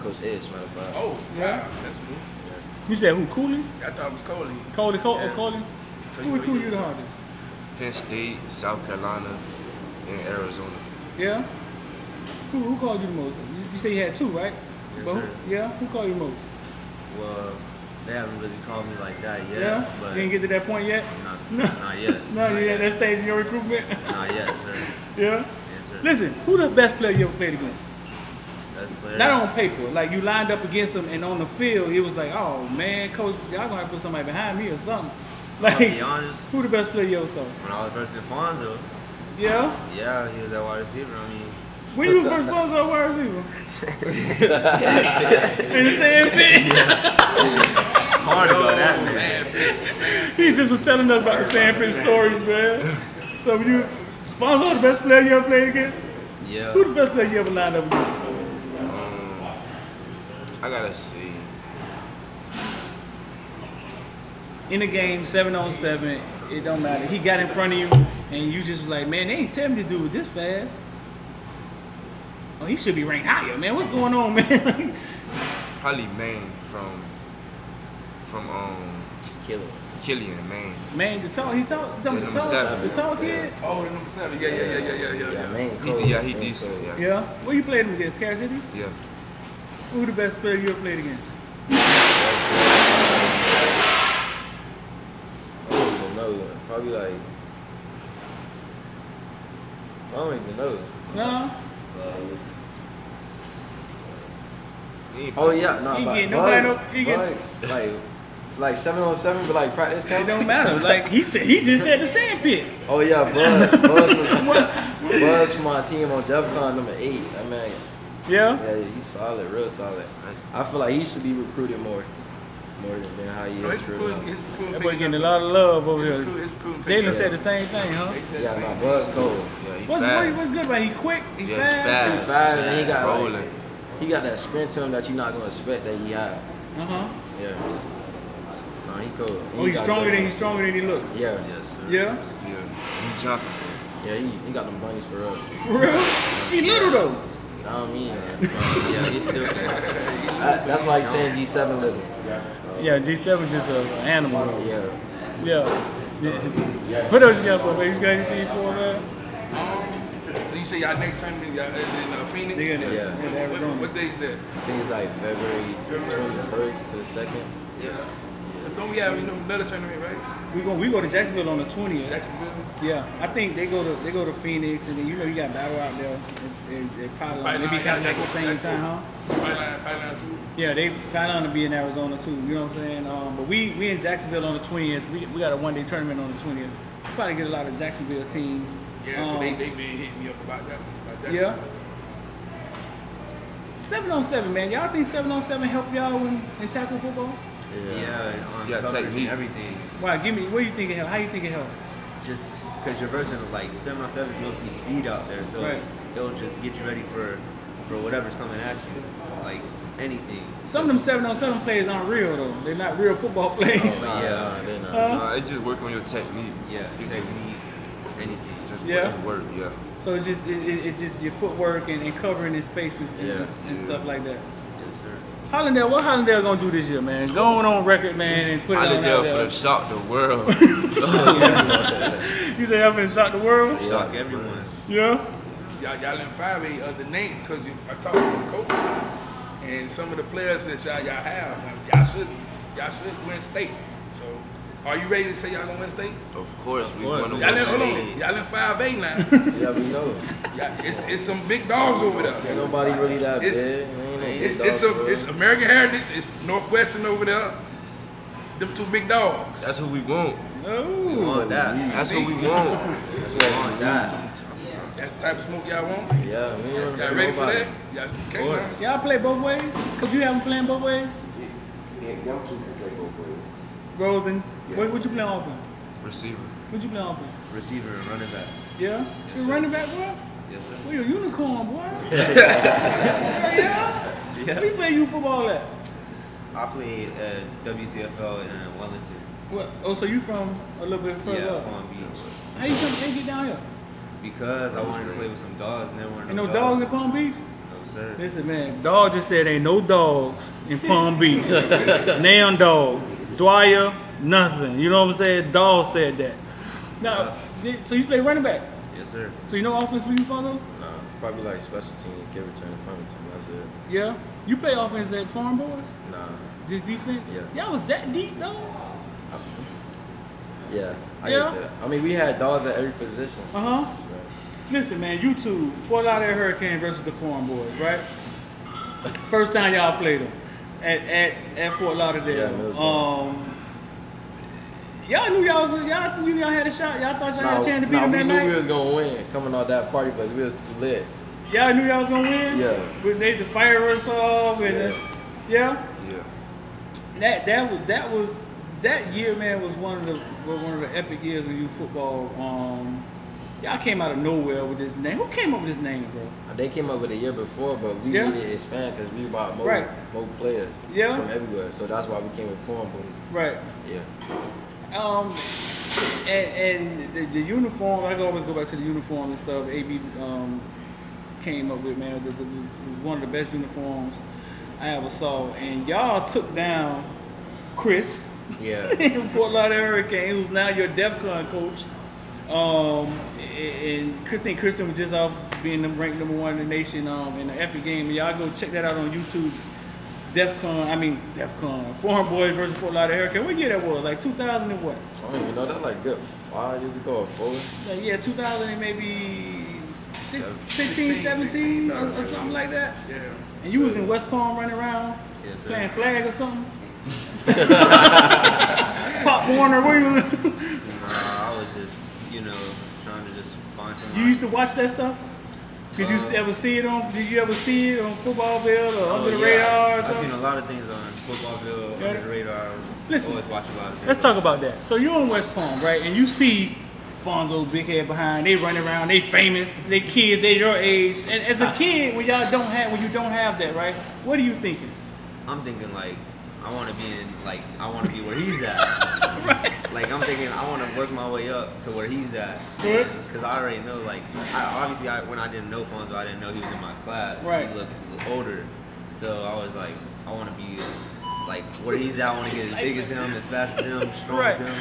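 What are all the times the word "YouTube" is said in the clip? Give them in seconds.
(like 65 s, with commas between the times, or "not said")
389 s.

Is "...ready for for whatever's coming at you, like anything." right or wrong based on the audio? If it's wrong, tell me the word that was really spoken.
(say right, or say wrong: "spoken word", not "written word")
right.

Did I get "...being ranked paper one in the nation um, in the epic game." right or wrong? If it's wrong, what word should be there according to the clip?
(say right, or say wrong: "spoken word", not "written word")
wrong: "number", not "paper".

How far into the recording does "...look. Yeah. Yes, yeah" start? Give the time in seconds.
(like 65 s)
140 s.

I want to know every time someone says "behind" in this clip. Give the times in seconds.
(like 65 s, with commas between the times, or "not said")
34 s, 428 s.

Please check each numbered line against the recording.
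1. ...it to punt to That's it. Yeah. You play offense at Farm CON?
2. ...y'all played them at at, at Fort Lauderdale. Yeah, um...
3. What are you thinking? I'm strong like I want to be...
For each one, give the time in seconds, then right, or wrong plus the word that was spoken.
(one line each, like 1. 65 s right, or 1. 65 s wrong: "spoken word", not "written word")
1. 312 s wrong: "Boys", not "CON"
2. 329 s right
3. 434 s wrong: "thinking", not "strong".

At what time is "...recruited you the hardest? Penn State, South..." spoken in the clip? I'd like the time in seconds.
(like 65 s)
6 s.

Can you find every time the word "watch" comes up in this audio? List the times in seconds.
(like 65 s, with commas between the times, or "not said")
414 s, 423 s.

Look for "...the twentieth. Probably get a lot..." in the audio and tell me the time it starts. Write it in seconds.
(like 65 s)
186 s.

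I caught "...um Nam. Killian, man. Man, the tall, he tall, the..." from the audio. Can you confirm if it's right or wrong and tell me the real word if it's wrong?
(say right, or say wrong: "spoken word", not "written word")
wrong: "Killian", not "Nam".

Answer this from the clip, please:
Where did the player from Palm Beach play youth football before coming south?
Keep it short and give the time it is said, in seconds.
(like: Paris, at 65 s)
WCFL in Wellington, at 287 s.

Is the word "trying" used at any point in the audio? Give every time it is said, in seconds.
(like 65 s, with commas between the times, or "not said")
413 s.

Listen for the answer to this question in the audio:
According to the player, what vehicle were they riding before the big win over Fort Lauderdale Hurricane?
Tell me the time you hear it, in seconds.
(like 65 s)
339 s.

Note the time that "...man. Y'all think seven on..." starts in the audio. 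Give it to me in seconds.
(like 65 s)
194 s.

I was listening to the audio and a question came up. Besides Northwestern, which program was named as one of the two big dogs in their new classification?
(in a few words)
American Heritage.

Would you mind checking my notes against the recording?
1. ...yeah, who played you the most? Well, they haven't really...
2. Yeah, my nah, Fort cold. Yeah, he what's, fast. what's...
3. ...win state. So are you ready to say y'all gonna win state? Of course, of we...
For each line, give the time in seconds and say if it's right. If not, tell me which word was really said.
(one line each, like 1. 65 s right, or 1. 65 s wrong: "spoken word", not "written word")
1. 15 s wrong: "called", not "played"
2. 128 s wrong: "Buzz", not "Fort"
3. 243 s right.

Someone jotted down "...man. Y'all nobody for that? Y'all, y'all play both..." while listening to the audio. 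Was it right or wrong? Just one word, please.
wrong.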